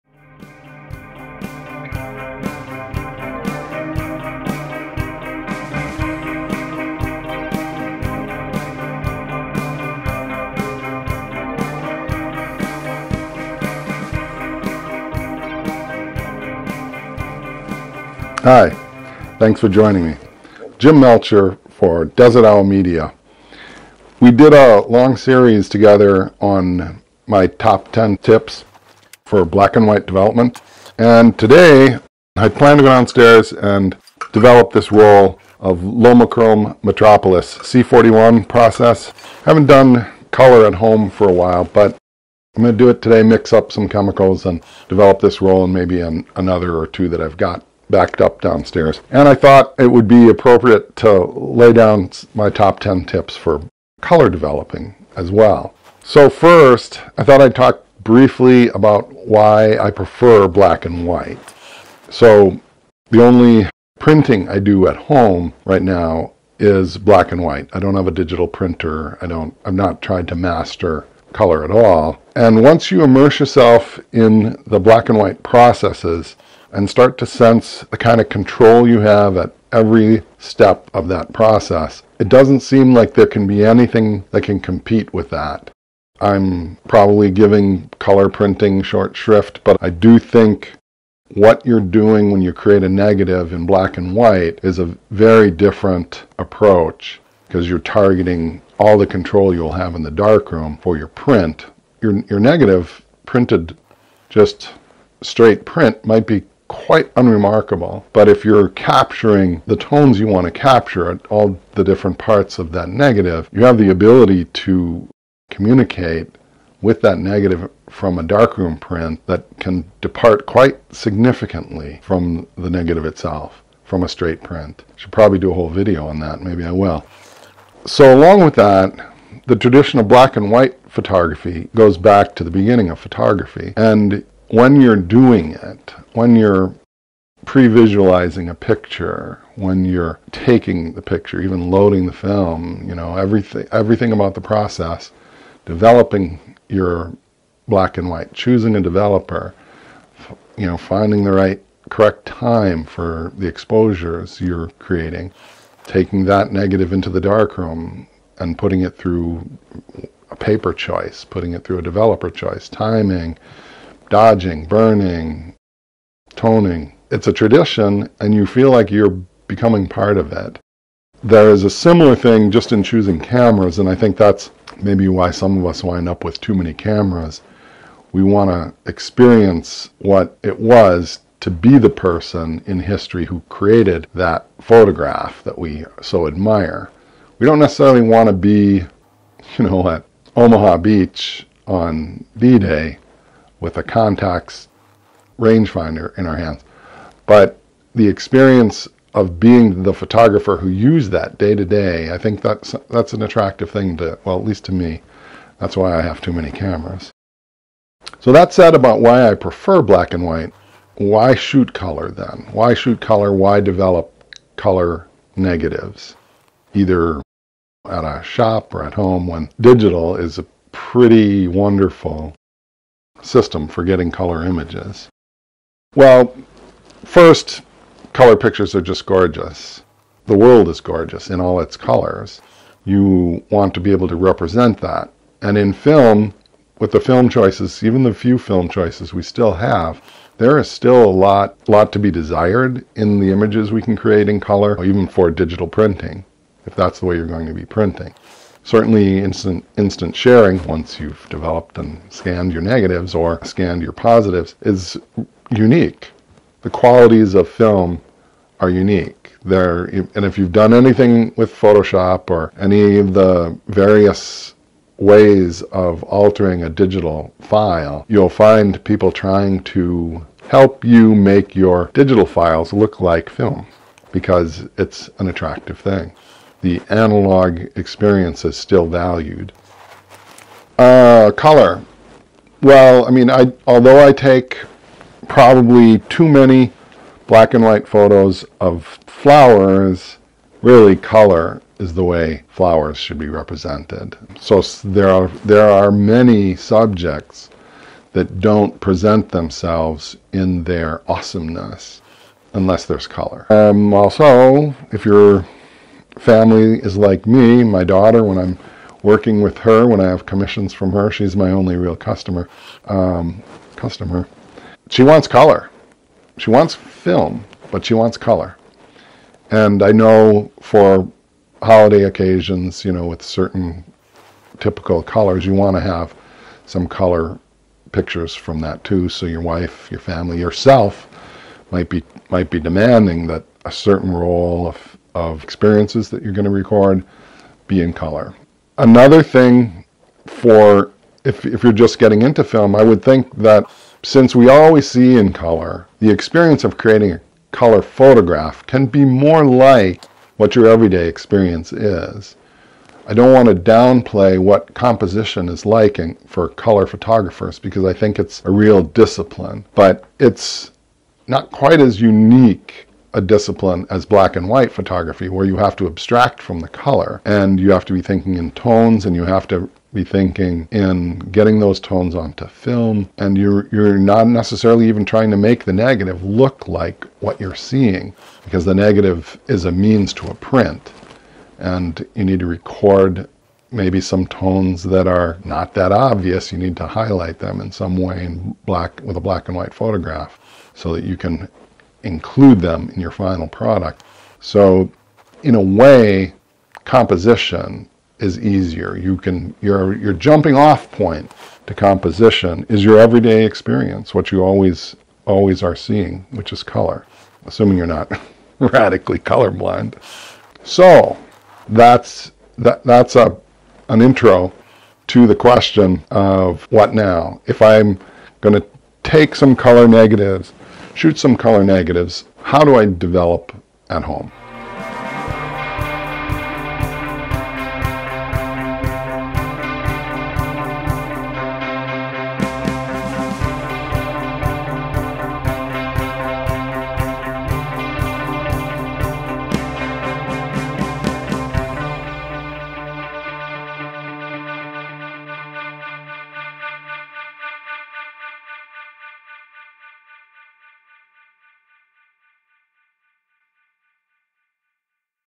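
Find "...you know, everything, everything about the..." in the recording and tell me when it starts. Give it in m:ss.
2:22.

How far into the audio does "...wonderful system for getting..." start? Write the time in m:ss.
3:41.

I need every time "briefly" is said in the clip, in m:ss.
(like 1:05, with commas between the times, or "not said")
0:58.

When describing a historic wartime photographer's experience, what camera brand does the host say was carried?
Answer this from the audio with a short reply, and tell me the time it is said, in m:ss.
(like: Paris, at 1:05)
Contax, at 3:13.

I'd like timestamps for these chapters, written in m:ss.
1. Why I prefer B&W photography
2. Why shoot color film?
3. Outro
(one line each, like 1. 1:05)
1. 1:00
2. 3:30
3. 6:50.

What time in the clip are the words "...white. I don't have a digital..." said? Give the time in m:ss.
1:07.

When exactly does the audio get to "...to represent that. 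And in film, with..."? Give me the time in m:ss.
3:54.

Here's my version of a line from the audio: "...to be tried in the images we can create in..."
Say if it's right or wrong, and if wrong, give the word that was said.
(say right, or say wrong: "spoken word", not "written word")
wrong: "desired", not "tried".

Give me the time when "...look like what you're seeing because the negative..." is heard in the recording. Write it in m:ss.
6:16.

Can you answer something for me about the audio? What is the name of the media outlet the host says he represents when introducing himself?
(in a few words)
Desert Owl Media.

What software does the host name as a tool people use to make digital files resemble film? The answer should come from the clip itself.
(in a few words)
Photoshop.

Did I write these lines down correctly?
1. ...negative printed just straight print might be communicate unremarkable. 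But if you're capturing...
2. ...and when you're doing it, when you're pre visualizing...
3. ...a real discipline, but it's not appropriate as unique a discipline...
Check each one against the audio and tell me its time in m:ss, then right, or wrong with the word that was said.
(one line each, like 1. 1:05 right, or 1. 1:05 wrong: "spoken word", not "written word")
1. 1:42 wrong: "quite", not "communicate"
2. 2:13 right
3. 5:58 wrong: "quite", not "appropriate".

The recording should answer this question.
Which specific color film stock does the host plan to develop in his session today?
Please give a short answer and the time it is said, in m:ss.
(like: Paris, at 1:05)
Lomochrome Metropolis, at 0:35.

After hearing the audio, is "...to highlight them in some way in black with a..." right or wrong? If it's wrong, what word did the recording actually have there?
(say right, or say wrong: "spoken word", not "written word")
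right.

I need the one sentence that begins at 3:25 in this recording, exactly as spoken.
That's why I have too many cameras.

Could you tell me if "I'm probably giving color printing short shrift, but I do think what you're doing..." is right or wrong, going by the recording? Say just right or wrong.
right.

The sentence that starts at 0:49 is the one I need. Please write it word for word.
And I thought it would be appropriate to lay down my top 10 tips for color developing as well.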